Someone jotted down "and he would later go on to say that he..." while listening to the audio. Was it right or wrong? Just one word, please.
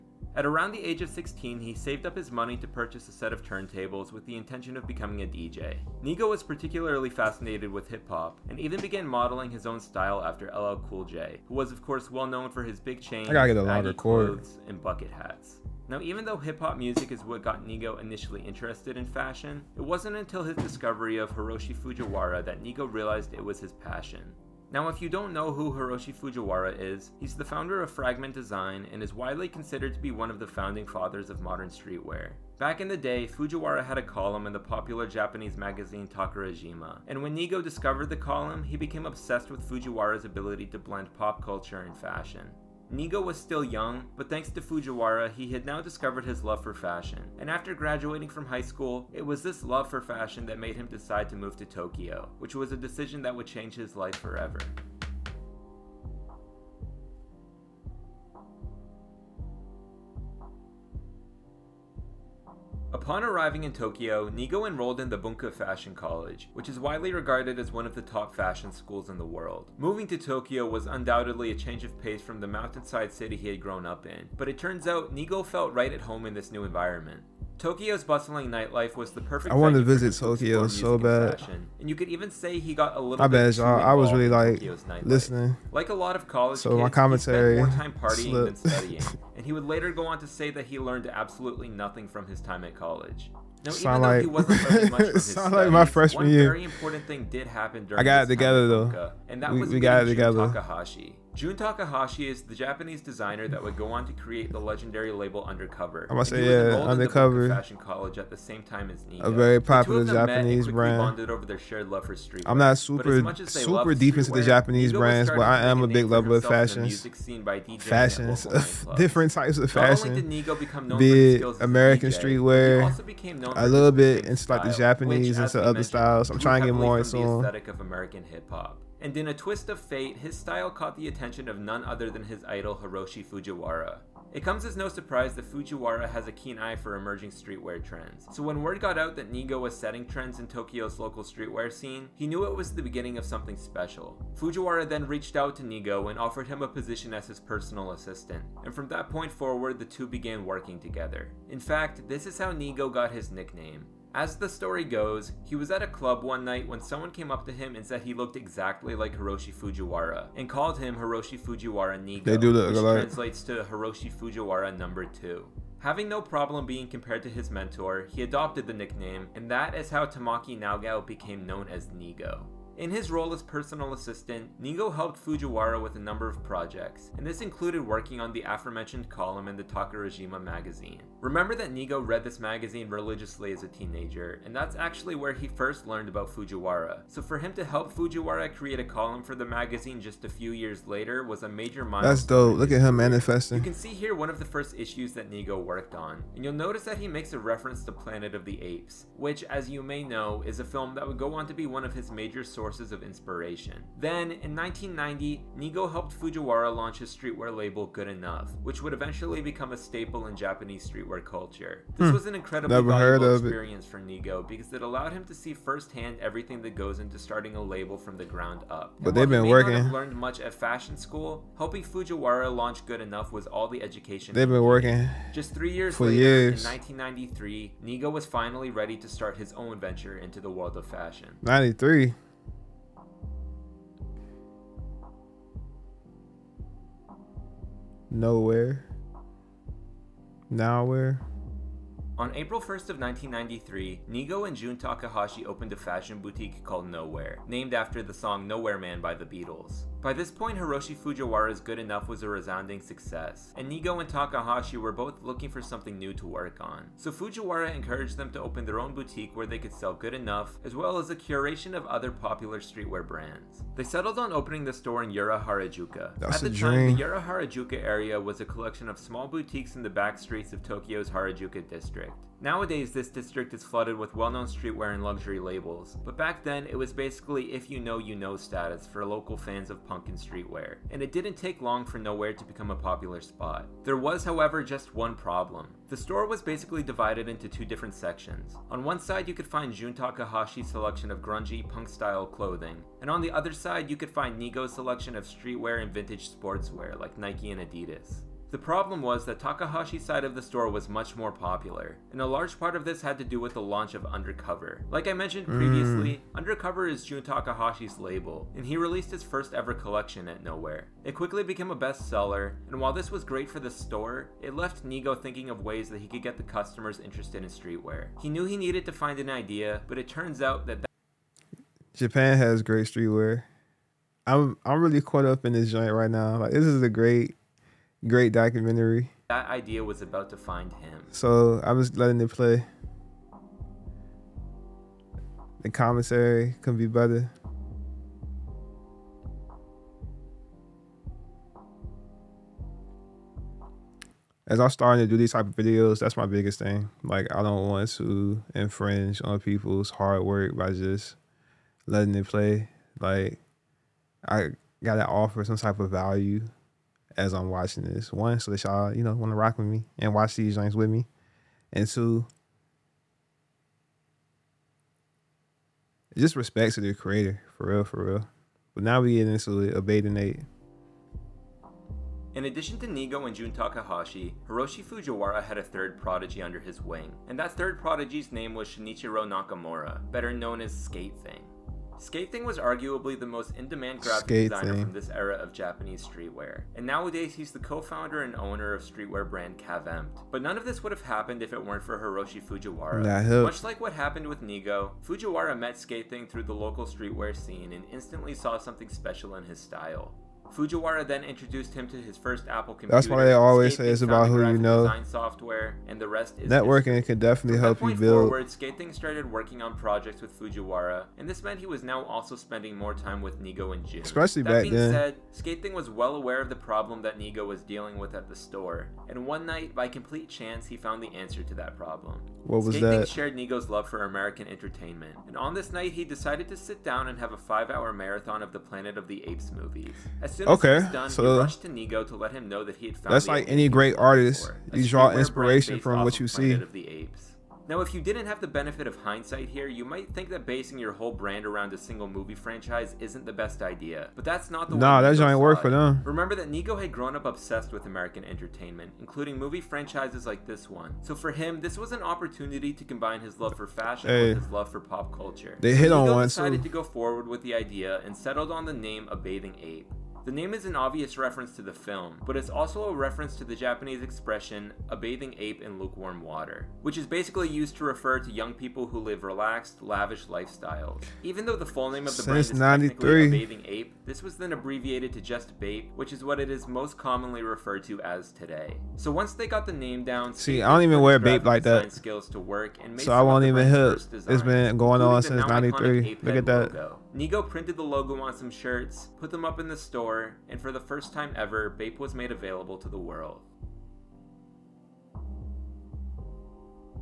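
right.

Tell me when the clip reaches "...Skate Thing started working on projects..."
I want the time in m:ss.
6:48.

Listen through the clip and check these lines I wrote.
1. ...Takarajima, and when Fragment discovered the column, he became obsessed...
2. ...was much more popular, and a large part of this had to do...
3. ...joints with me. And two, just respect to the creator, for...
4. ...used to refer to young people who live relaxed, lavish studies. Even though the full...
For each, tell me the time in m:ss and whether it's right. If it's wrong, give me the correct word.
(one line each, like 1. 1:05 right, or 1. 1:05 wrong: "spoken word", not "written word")
1. 0:36 wrong: "Nigo", not "Fragment"
2. 5:00 right
3. 6:00 right
4. 7:47 wrong: "lifestyles", not "studies".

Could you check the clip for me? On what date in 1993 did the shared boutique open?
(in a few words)
April 1st.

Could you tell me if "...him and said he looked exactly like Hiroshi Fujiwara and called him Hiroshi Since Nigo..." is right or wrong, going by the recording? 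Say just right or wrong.
wrong.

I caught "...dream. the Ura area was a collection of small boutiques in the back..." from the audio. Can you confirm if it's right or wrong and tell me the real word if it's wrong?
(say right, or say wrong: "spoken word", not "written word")
right.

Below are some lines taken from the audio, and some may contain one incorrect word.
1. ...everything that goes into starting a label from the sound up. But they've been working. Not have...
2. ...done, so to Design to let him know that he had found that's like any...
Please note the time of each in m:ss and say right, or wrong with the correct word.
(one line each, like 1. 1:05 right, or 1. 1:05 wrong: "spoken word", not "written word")
1. 3:36 wrong: "ground", not "sound"
2. 7:10 wrong: "Nigo", not "Design".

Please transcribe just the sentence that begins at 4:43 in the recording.
There was however just one problem.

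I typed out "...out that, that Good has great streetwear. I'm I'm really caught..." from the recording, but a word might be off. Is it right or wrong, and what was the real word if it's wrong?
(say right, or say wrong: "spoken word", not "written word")
wrong: "Japan", not "Good".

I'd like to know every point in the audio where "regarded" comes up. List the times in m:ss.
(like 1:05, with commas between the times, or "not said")
1:07.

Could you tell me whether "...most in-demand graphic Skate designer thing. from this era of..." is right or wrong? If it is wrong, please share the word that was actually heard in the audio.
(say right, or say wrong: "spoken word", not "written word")
right.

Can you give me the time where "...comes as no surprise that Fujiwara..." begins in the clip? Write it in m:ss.
2:14.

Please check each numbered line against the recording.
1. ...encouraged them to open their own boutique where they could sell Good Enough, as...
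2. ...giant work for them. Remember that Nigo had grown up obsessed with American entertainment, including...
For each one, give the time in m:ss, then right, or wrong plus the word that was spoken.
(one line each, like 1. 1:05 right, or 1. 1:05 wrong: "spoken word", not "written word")
1. 4:17 right
2. 7:25 right.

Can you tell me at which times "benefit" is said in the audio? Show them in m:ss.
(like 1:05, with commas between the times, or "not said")
7:18.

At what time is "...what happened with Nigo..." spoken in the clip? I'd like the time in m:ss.
6:33.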